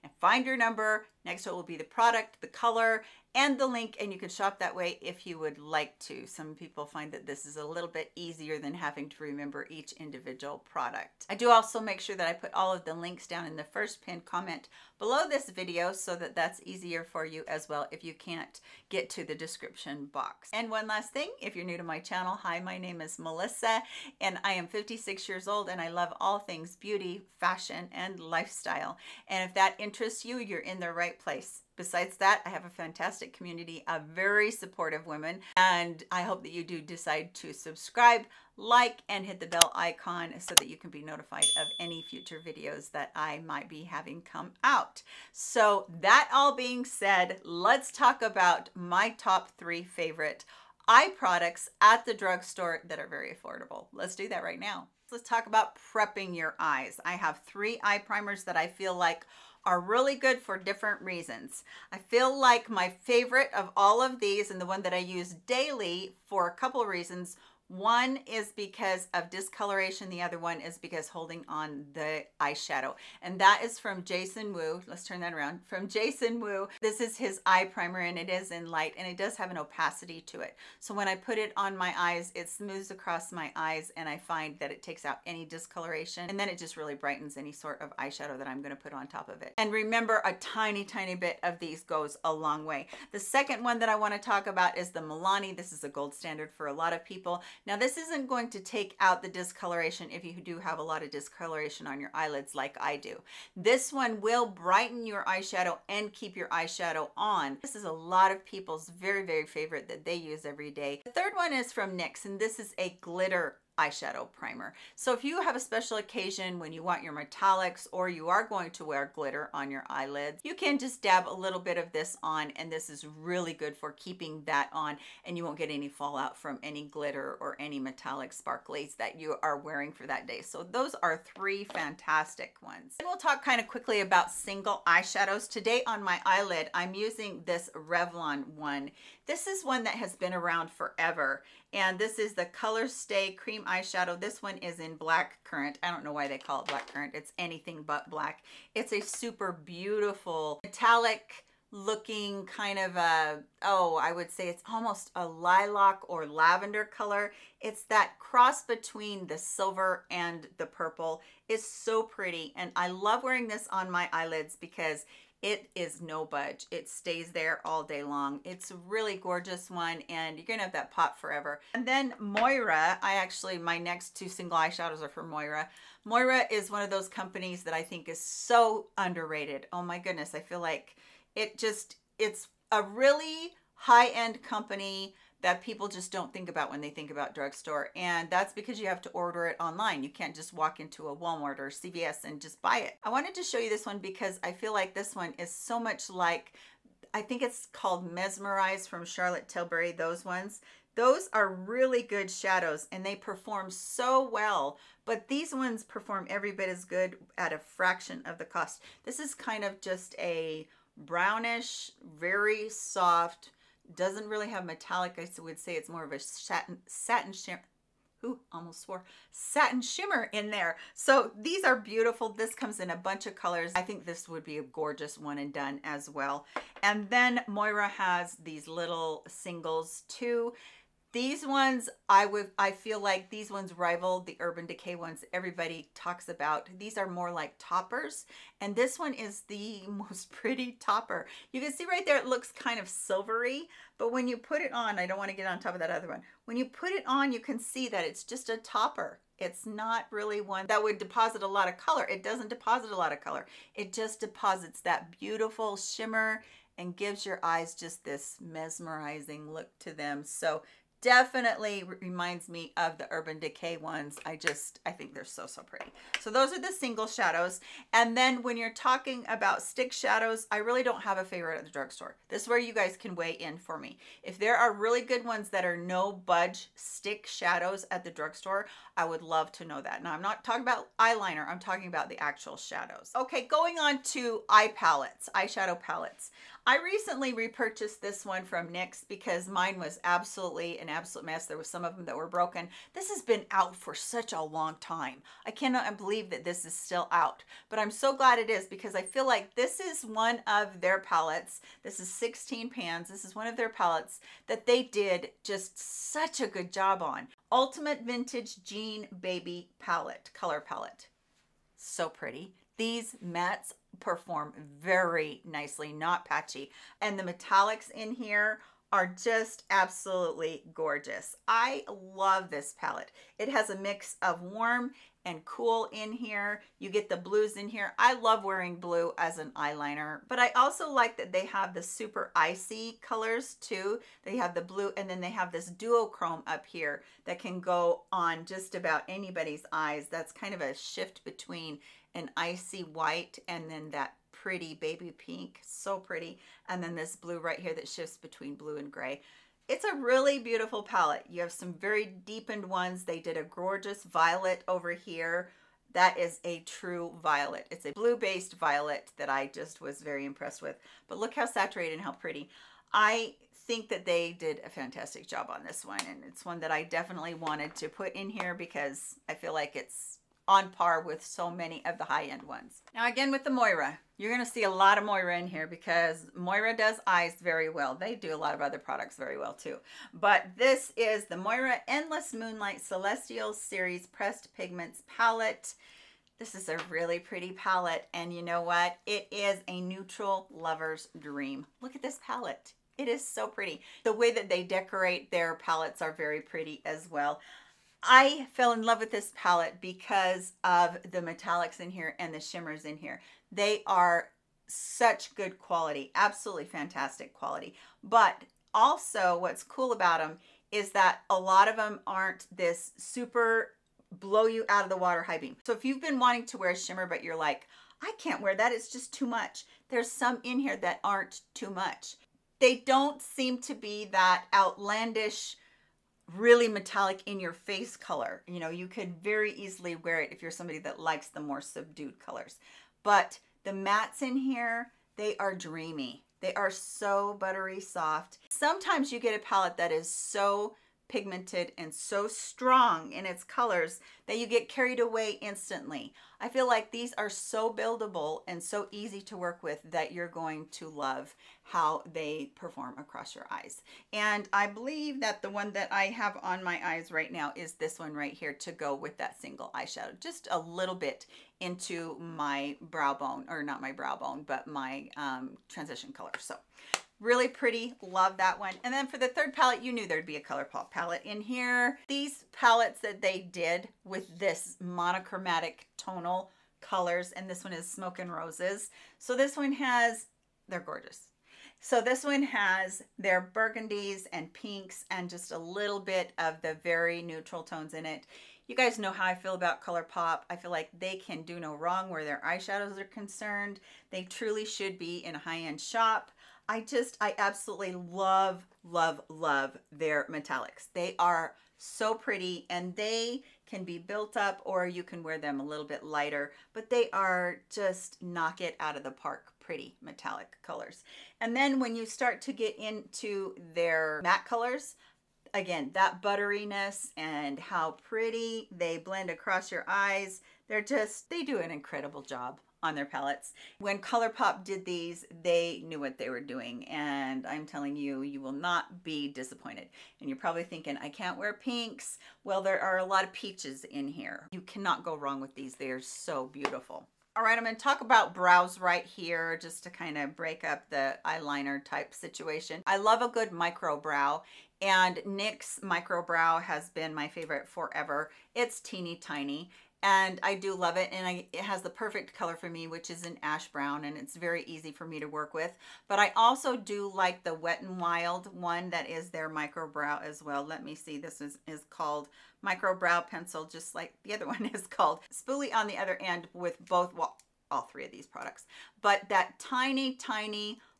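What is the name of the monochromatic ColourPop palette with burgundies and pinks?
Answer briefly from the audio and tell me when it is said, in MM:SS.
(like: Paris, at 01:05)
Smoke and Roses, at 07:57.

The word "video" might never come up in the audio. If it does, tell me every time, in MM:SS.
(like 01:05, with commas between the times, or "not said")
00:15, 00:42.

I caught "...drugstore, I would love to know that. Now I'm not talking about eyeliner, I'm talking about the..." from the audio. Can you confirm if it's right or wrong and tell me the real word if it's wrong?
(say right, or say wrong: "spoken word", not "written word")
right.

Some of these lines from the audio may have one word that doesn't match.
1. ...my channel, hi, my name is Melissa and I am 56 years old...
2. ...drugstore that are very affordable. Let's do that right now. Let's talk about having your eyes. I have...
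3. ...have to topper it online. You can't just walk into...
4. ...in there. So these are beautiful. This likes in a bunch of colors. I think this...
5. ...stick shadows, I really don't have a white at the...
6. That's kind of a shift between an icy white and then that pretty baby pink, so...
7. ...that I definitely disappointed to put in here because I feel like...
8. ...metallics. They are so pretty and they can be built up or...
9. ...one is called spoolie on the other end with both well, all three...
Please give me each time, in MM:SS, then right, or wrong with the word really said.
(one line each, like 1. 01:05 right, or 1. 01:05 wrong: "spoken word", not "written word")
1. 00:21 right
2. 00:52 wrong: "prepping", not "having"
3. 03:08 wrong: "order", not "topper"
4. 03:40 wrong: "comes", not "likes"
5. 04:29 wrong: "favorite", not "white"
6. 05:40 right
7. 06:06 wrong: "wanted", not "disappointed"
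8. 08:20 right
9. 09:24 right.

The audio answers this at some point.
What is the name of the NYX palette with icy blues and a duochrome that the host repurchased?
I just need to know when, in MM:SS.
05:07.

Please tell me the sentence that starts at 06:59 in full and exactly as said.
There's some in here that aren't too much.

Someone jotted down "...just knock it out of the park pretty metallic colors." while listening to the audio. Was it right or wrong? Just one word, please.
right.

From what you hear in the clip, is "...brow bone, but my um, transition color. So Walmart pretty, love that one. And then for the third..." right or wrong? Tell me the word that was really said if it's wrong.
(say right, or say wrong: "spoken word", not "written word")
wrong: "Really", not "Walmart".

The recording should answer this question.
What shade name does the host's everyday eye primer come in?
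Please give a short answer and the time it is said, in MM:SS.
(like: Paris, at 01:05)
light, at 01:18.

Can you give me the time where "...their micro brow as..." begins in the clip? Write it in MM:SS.
09:19.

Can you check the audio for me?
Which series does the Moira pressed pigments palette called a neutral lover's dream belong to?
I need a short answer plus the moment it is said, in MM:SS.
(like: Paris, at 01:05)
Endless Moonlight Celestial, at 06:21.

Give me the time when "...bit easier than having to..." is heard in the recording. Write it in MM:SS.
00:07.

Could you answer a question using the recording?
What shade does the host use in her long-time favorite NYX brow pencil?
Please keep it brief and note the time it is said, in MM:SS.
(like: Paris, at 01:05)
ash brown, at 09:13.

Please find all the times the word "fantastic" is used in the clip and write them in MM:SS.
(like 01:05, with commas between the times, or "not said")
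00:32, 02:11, 06:04, 06:46.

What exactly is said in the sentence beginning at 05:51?
You have some very deepened ones.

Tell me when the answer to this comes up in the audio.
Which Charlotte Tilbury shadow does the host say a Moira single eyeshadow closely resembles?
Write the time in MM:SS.
03:18.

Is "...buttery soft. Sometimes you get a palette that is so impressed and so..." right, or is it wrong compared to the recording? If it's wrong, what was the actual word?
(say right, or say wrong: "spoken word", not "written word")
wrong: "pigmented", not "impressed".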